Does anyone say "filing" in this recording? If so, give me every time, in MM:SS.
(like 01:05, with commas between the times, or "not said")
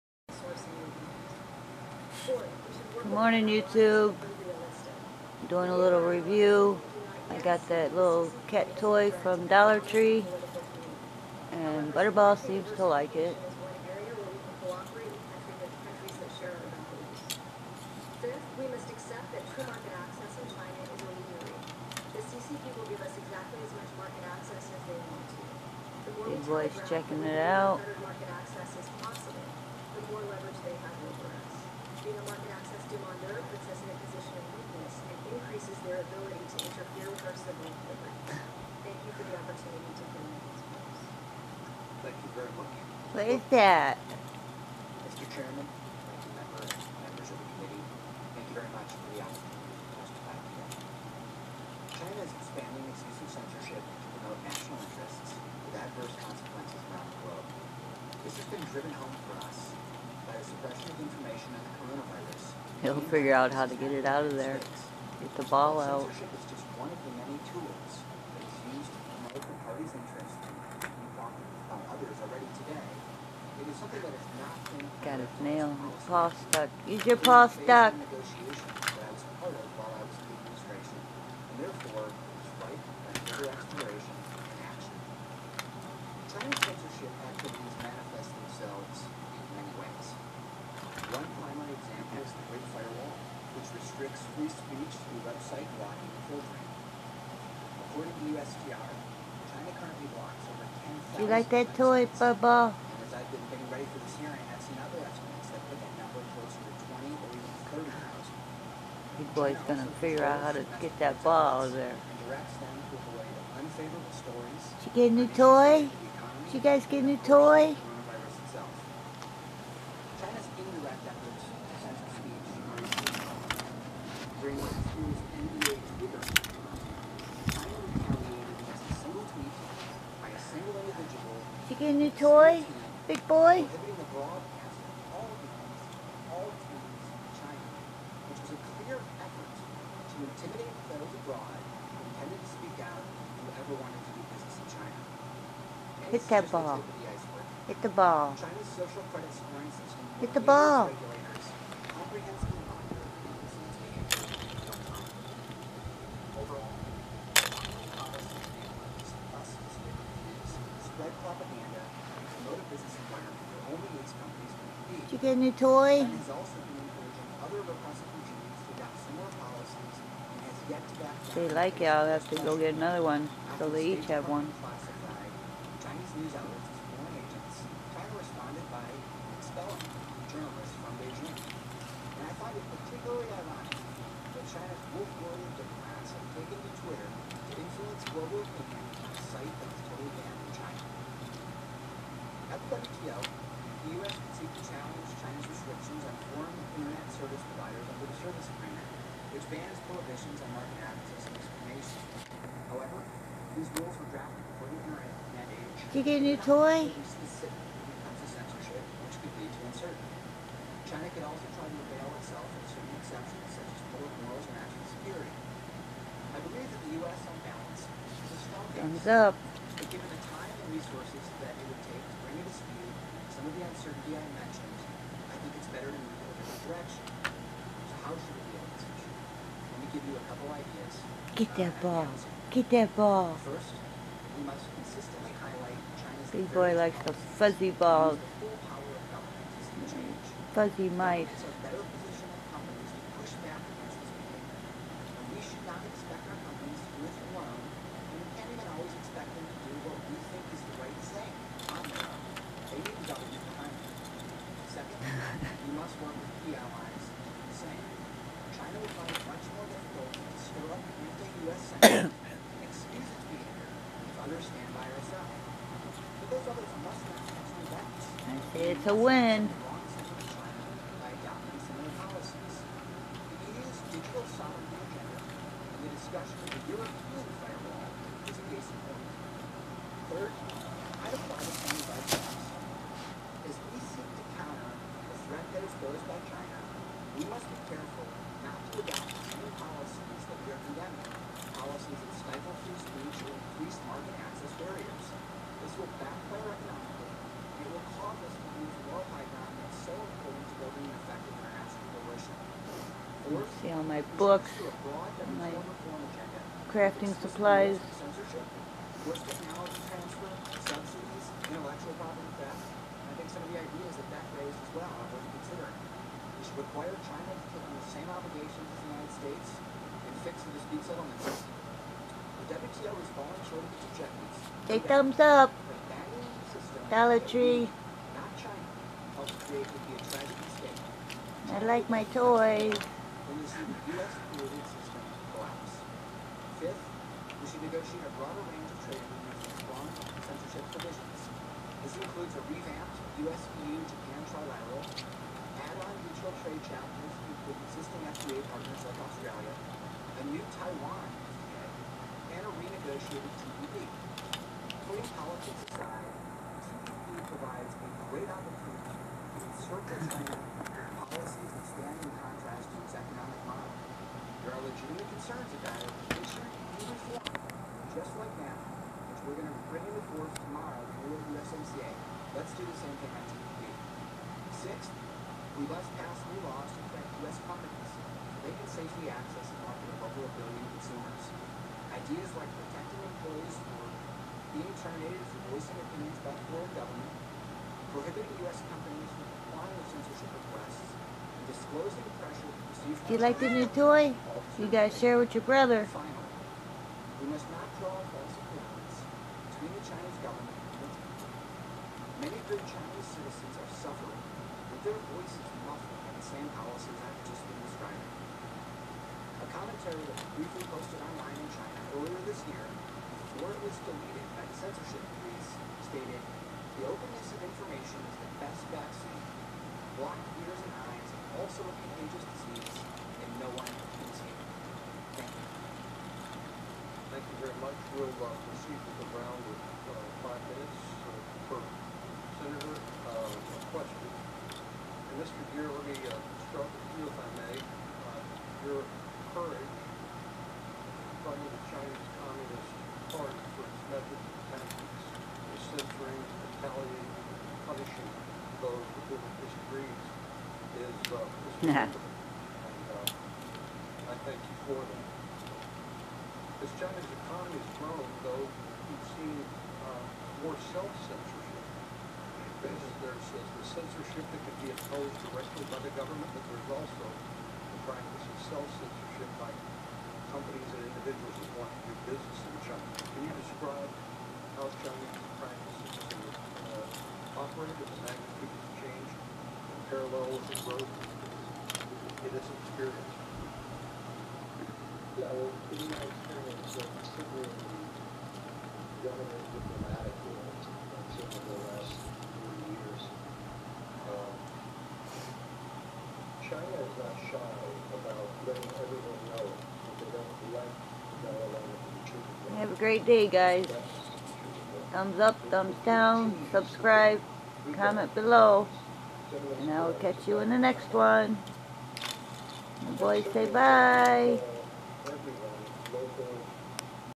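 not said.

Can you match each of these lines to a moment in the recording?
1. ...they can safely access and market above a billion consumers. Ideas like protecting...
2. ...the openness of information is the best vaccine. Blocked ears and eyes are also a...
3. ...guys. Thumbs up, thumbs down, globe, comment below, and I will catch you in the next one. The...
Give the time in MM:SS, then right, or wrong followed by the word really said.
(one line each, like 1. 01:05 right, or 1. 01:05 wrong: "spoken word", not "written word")
1. 06:18 right
2. 06:56 right
3. 08:23 wrong: "subscribe", not "globe".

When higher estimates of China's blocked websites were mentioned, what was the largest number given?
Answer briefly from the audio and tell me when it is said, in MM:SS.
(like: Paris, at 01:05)
30,000, at 01:47.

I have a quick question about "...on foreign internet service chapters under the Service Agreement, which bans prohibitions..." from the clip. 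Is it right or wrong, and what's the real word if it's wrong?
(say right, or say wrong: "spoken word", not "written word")
wrong: "providers", not "chapters".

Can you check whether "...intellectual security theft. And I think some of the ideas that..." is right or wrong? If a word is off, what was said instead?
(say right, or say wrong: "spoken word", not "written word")
wrong: "property", not "security".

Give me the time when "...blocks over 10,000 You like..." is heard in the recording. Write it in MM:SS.
01:40.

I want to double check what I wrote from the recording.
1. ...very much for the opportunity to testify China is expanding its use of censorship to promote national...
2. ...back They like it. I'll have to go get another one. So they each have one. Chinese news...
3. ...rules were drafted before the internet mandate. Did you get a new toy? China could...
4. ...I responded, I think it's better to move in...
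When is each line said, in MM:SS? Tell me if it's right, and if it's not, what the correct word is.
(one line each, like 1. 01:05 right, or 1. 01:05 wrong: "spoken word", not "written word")
1. 00:48 right
2. 02:51 right
3. 03:23 right
4. 03:44 wrong: "mentioned", not "responded".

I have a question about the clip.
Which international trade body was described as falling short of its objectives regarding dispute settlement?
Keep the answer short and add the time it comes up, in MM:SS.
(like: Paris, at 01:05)
WTO, at 05:22.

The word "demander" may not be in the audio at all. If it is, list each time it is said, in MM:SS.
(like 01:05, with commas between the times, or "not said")
00:32.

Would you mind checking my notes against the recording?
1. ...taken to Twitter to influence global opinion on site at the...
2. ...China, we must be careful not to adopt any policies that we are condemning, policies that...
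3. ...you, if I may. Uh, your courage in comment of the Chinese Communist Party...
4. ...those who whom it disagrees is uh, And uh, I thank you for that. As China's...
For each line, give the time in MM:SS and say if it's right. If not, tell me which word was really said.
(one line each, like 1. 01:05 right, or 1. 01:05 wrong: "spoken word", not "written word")
1. 03:06 right
2. 04:46 right
3. 07:16 wrong: "front", not "comment"
4. 07:28 right.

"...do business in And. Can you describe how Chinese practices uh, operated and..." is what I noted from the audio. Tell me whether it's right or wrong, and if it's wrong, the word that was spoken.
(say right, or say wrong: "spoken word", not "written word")
wrong: "China", not "And".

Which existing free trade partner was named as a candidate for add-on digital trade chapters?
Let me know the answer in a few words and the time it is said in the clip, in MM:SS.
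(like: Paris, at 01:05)
Australia, at 05:48.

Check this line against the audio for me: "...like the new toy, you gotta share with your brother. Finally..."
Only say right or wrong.
right.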